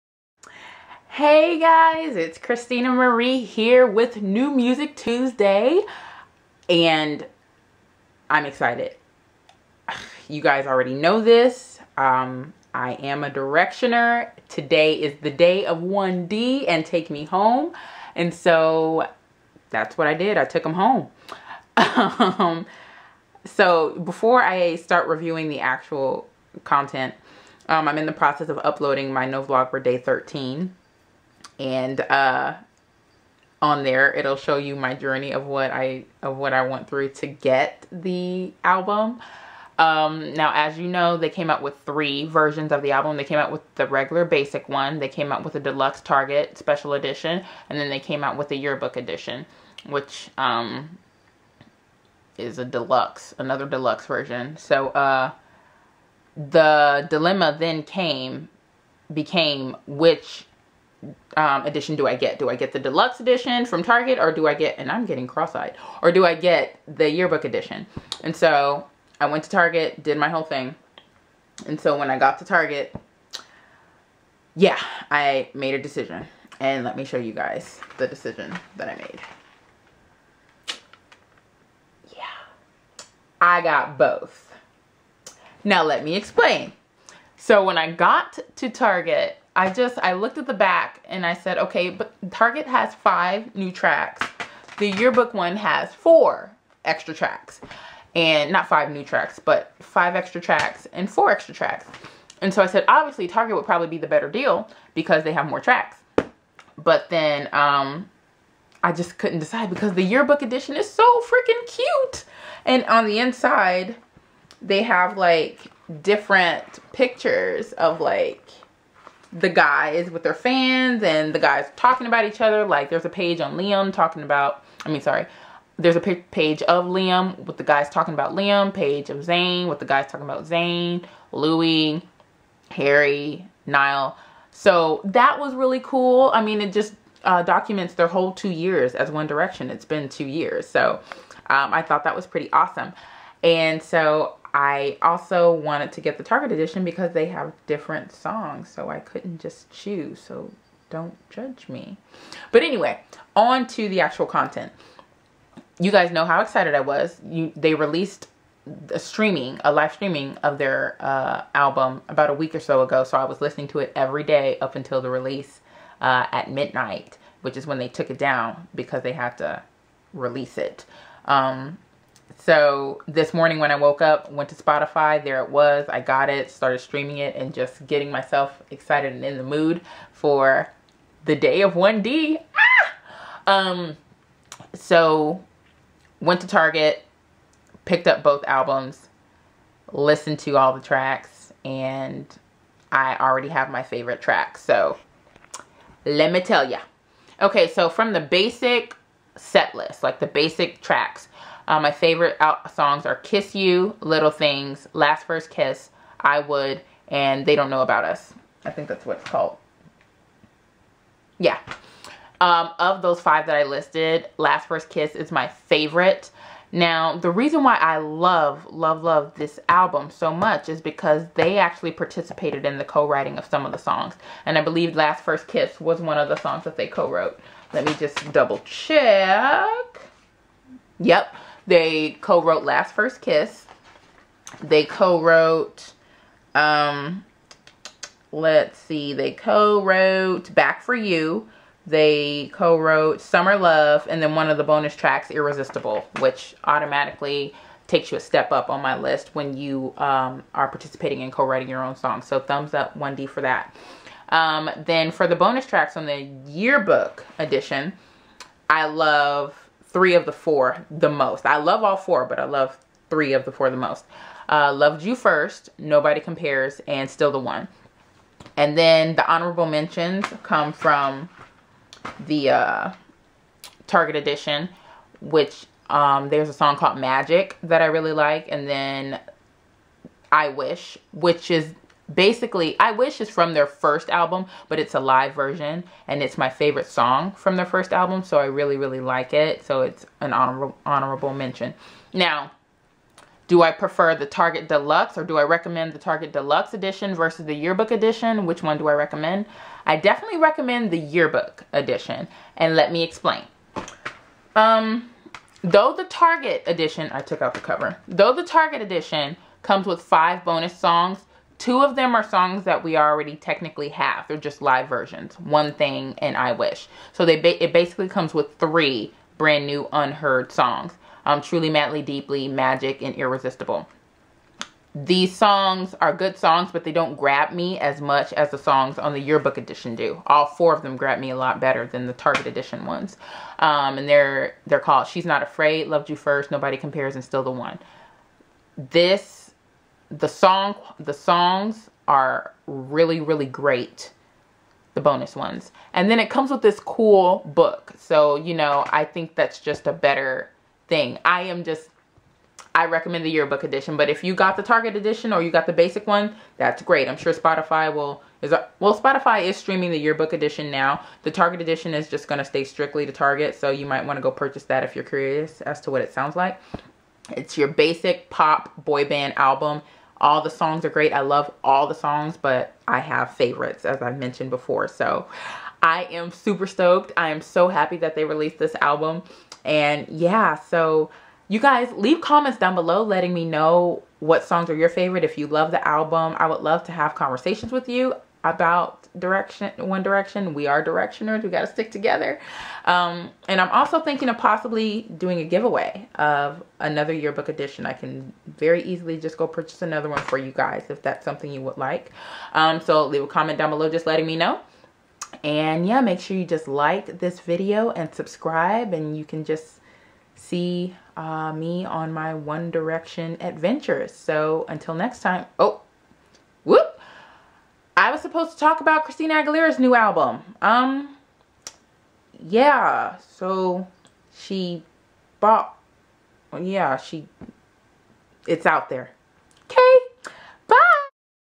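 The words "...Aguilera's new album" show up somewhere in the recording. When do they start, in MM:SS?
06:59.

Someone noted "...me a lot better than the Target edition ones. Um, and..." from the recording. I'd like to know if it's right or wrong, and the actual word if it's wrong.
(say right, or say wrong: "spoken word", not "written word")
right.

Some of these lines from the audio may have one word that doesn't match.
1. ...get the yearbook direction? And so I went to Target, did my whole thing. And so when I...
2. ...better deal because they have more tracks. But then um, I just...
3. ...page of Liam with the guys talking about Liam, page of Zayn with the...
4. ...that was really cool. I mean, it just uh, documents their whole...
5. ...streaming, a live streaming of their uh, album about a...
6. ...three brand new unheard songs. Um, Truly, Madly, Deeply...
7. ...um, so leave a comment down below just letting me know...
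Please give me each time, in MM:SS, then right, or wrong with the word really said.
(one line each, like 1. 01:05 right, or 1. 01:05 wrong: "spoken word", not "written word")
1. 01:06 wrong: "edition", not "direction"
2. 01:44 right
3. 02:06 right
4. 02:15 right
5. 02:38 right
6. 05:18 right
7. 06:42 right.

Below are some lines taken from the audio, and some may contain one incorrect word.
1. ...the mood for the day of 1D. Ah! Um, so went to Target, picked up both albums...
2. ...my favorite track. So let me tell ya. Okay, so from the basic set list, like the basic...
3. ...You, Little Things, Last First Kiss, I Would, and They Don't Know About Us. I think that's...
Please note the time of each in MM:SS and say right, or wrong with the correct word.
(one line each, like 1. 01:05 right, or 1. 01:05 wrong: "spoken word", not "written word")
1. 02:59 right
2. 03:13 right
3. 03:23 right.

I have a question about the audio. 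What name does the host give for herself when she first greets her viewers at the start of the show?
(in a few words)
Christina Marie.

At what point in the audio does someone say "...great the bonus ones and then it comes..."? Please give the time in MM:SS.
05:43.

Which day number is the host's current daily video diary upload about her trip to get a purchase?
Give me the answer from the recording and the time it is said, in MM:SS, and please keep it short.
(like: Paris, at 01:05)
13, at 00:29.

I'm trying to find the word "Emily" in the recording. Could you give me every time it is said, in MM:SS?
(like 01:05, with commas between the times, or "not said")
not said.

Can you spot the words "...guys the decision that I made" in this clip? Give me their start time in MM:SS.
01:17.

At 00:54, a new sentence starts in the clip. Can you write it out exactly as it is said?
So uh, the dilemma then came, became which um, edition do I get?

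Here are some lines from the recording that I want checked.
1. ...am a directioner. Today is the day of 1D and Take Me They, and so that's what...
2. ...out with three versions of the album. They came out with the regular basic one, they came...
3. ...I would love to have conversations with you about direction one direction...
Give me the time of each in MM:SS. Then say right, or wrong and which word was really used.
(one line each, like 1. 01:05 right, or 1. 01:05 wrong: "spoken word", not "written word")
1. 00:12 wrong: "Home", not "They"
2. 00:41 right
3. 06:26 right.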